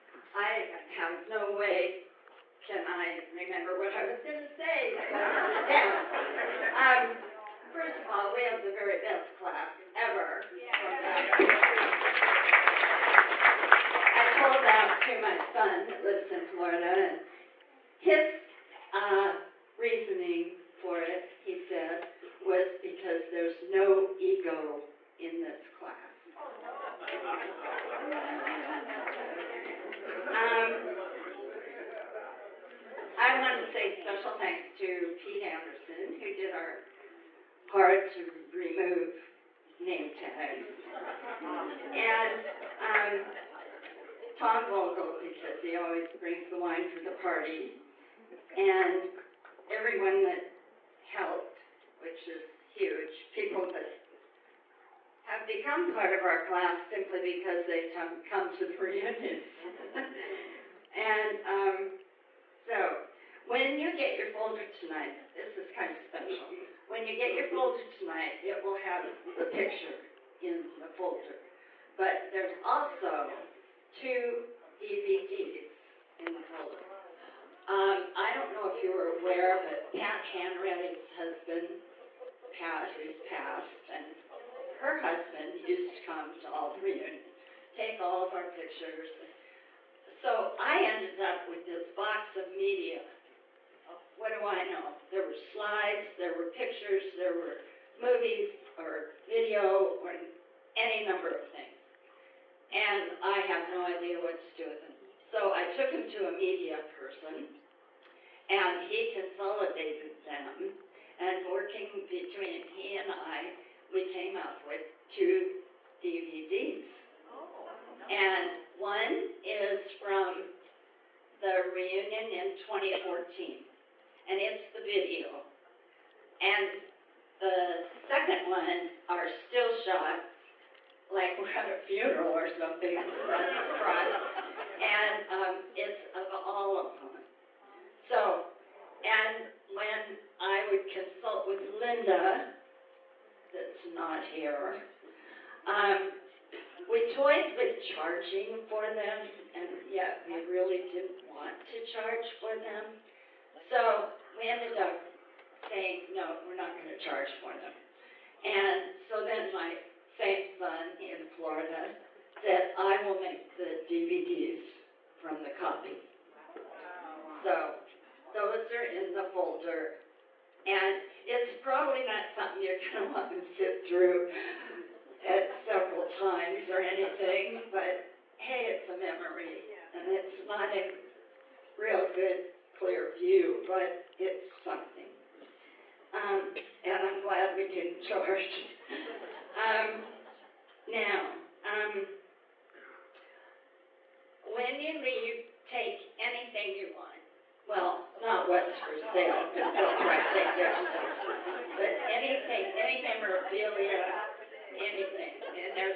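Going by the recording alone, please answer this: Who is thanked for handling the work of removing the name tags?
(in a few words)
Pete Anderson.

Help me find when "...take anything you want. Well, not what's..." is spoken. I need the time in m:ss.
3:15.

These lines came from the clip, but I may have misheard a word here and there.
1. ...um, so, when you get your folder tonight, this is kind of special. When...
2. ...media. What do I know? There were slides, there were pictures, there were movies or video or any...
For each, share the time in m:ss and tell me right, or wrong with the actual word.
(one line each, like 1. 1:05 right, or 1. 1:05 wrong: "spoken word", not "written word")
1. 1:01 right
2. 1:32 right.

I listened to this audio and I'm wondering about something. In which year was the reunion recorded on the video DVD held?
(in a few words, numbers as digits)
2014.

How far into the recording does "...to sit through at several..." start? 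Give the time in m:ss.
2:53.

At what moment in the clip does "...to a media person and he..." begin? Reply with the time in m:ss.
1:46.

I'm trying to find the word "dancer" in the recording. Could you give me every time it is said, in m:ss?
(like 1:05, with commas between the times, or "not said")
not said.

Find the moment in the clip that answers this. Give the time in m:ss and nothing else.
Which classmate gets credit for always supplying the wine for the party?
0:44.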